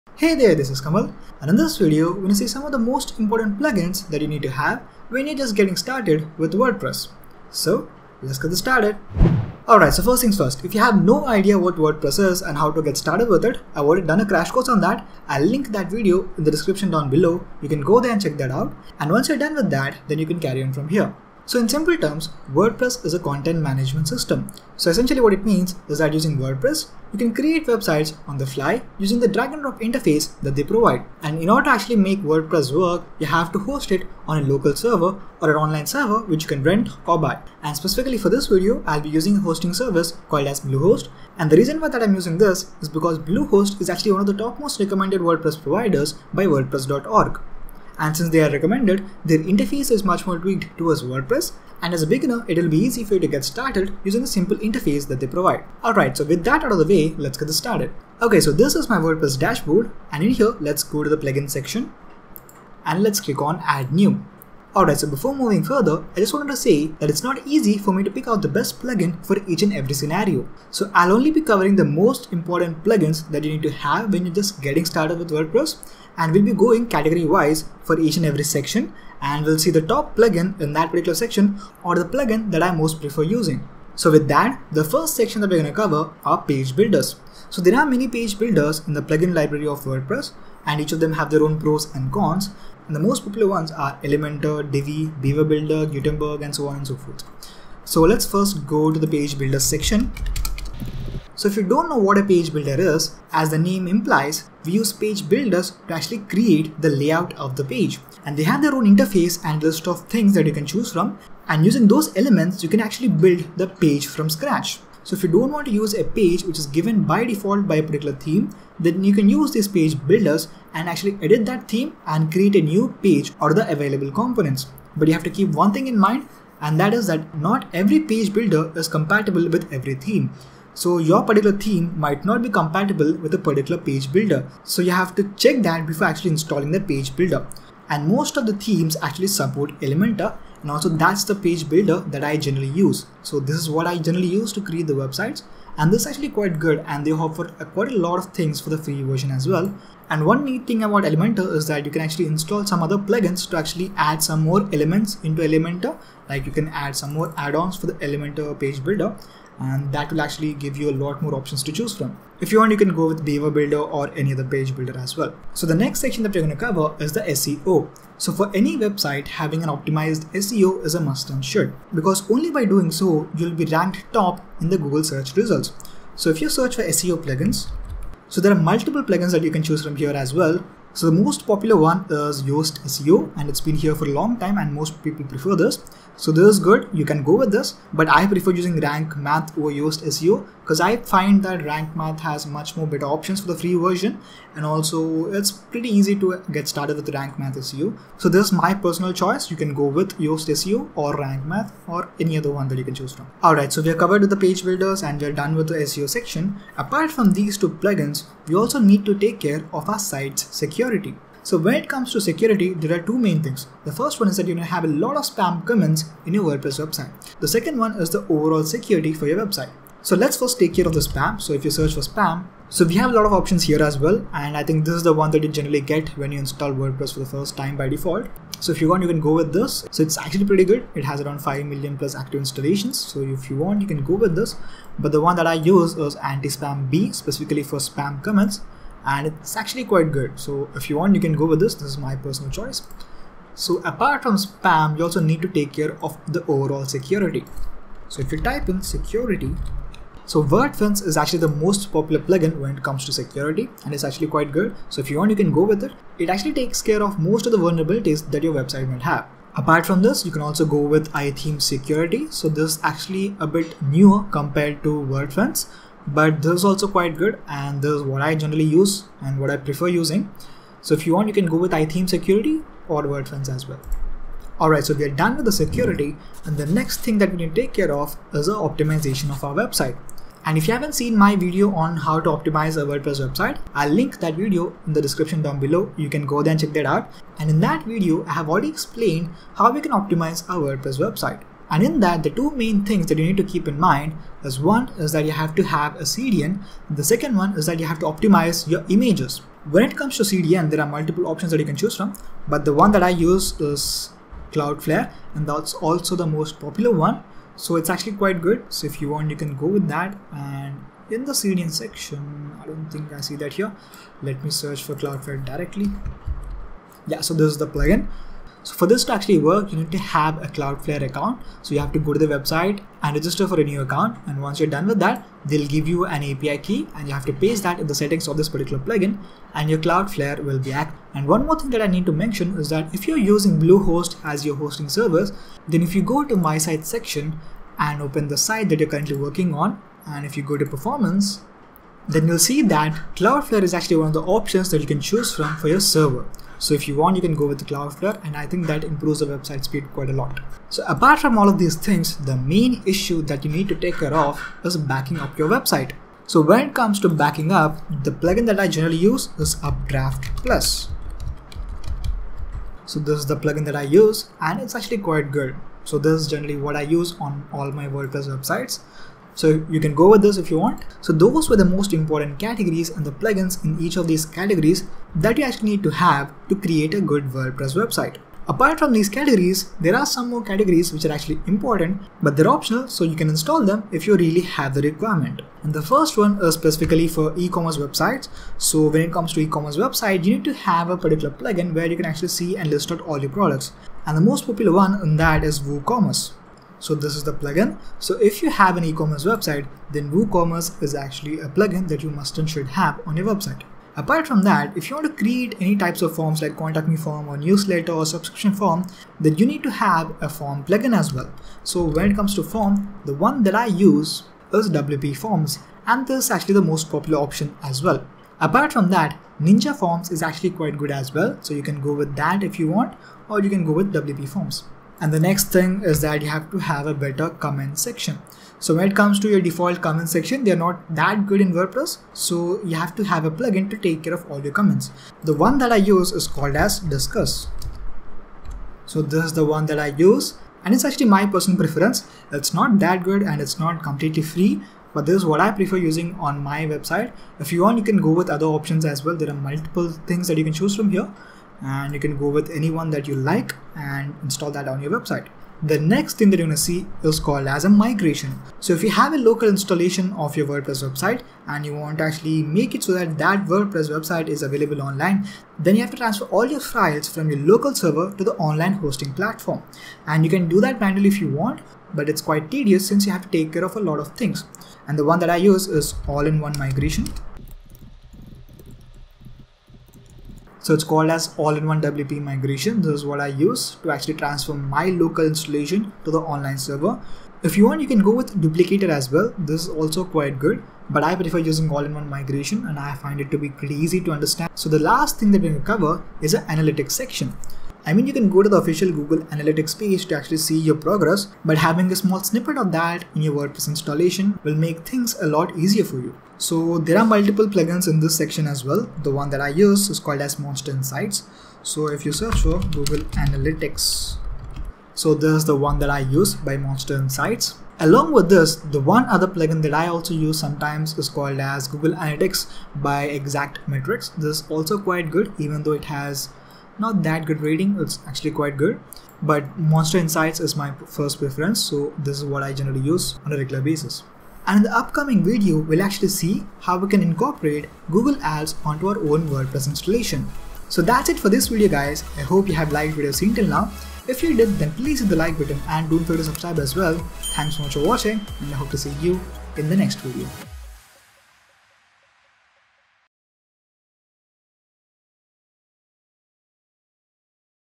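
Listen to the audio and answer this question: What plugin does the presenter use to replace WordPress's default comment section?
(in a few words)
Disqus.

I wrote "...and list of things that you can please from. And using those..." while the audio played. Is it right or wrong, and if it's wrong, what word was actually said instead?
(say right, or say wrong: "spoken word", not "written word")
wrong: "choose", not "please".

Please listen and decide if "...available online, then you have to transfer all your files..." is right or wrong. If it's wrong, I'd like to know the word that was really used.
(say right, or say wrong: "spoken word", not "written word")
right.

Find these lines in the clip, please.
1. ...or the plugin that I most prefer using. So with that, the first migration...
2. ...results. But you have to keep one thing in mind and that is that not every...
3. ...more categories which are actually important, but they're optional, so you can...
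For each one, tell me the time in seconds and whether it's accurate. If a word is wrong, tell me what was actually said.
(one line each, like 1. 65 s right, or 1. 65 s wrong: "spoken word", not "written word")
1. 81 s wrong: "section", not "migration"
2. 124 s wrong: "components", not "results"
3. 380 s right.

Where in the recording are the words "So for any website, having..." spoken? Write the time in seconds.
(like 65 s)
168 s.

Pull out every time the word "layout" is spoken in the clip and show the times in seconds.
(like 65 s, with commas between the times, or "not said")
106 s.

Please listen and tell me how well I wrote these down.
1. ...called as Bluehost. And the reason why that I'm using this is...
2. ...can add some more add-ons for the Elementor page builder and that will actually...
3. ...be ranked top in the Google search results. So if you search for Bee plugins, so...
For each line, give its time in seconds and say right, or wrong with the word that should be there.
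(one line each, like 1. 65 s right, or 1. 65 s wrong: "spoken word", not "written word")
1. 40 s right
2. 156 s right
3. 173 s wrong: "SEO", not "Bee".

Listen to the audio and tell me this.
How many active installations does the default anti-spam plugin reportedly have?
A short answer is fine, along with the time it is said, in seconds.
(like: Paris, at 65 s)
5 million plus, at 231 s.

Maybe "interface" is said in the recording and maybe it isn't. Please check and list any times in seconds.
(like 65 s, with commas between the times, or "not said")
29 s, 49 s, 54 s, 108 s.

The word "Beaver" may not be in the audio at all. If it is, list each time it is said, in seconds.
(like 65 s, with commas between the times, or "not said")
95 s, 163 s.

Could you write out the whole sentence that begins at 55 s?
Alright, so with that out of the way, let's get this started.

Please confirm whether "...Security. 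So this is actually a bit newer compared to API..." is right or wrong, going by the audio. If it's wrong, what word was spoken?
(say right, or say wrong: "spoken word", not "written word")
wrong: "WordFence", not "API".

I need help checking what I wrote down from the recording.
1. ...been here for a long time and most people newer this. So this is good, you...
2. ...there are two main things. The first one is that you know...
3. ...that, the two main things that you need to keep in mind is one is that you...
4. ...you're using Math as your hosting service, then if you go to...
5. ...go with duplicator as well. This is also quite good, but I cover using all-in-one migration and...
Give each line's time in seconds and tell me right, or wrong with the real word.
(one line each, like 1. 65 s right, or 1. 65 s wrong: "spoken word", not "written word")
1. 183 s wrong: "prefer", not "newer"
2. 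212 s right
3. 292 s right
4. 333 s wrong: "Bluehost", not "Math"
5. 488 s wrong: "prefer", not "cover".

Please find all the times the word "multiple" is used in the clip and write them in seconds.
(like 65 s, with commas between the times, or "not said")
178 s, 300 s, 449 s, 507 s.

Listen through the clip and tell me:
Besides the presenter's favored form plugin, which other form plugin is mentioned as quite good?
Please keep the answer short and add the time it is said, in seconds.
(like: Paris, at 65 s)
Ninja Forms, at 419 s.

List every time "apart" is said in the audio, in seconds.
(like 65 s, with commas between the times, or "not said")
206 s, 243 s, 259 s, 350 s, 378 s, 403 s, 418 s.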